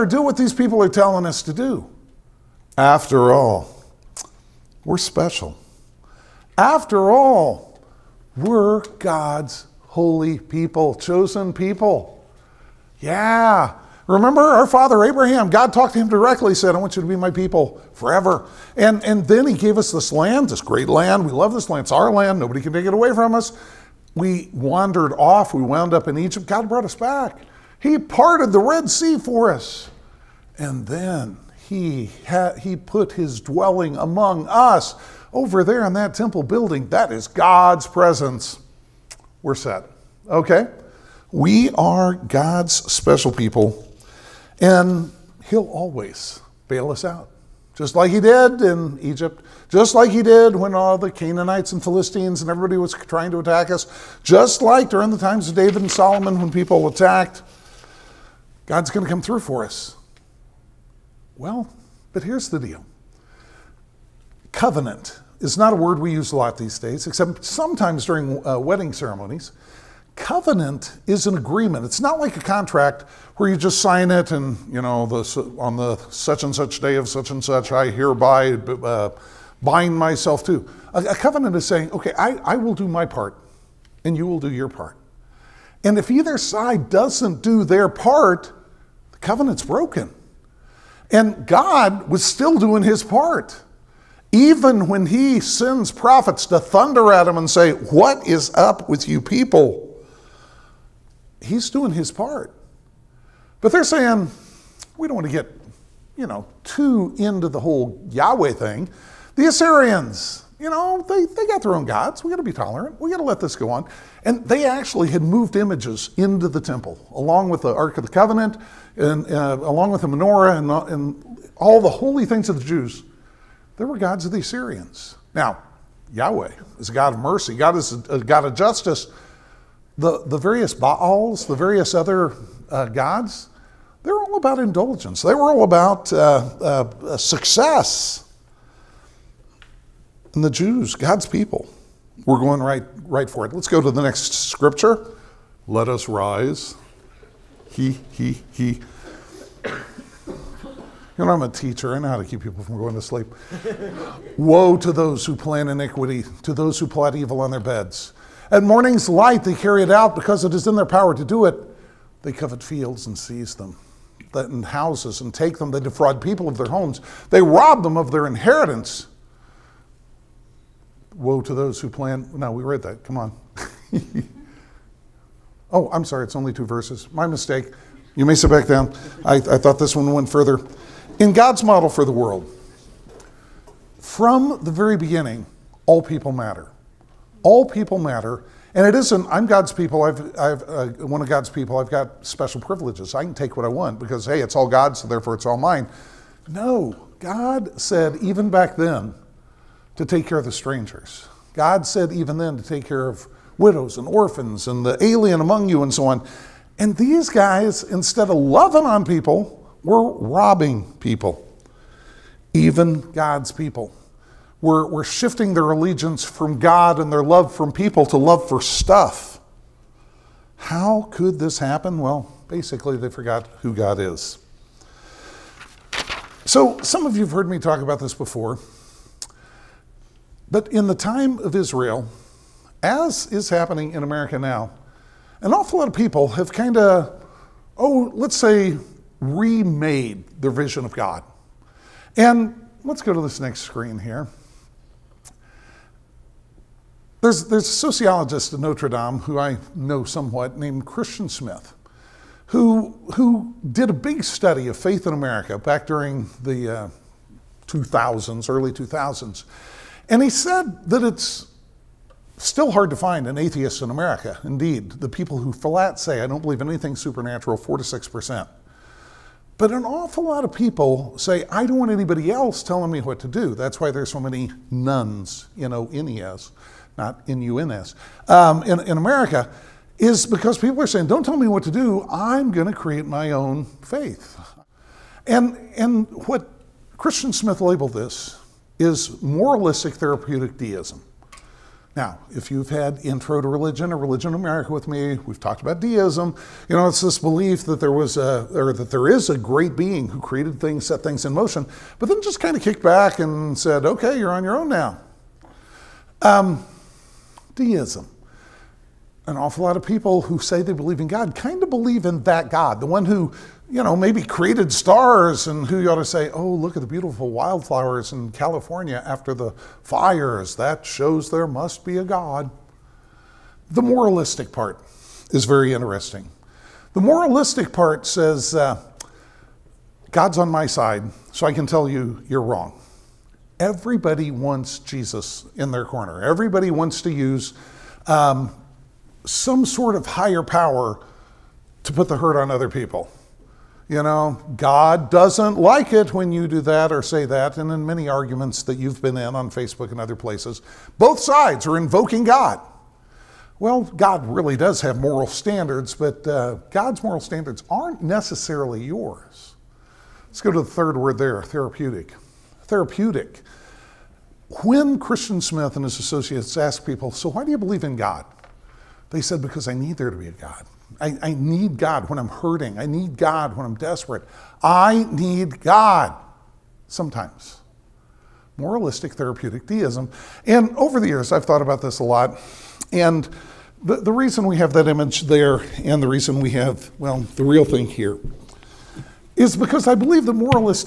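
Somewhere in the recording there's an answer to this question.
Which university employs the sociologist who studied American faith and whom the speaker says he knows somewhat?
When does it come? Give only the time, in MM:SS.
04:08.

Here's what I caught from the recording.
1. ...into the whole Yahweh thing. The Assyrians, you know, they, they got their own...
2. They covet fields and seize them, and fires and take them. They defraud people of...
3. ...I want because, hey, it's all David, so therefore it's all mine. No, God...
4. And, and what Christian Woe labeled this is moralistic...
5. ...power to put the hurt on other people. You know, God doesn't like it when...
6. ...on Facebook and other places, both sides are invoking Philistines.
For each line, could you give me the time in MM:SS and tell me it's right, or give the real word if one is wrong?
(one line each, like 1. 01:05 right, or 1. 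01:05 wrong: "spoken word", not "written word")
1. 01:47 right
2. 02:42 wrong: "houses", not "fires"
3. 03:13 wrong: "God", not "David"
4. 04:45 wrong: "Smith", not "Woe"
5. 05:40 right
6. 05:49 wrong: "God", not "Philistines".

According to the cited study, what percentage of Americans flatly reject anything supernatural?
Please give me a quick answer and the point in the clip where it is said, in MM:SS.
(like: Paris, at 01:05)
4 to 6%, at 04:27.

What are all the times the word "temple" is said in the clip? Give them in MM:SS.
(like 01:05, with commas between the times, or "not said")
00:36, 01:56.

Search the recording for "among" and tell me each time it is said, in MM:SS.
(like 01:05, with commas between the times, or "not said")
00:33, 03:25.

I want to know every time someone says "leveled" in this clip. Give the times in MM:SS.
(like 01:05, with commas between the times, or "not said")
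not said.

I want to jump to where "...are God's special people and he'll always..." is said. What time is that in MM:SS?
00:41.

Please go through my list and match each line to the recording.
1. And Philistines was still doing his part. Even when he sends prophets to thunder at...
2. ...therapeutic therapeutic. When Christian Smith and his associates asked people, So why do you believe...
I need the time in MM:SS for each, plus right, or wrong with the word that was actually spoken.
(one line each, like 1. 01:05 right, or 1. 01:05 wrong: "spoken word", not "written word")
1. 01:31 wrong: "God", not "Philistines"
2. 06:01 right.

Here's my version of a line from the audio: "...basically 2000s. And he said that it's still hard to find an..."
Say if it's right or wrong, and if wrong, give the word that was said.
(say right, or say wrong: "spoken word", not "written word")
wrong: "early", not "basically".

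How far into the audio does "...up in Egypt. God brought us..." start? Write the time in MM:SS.
00:25.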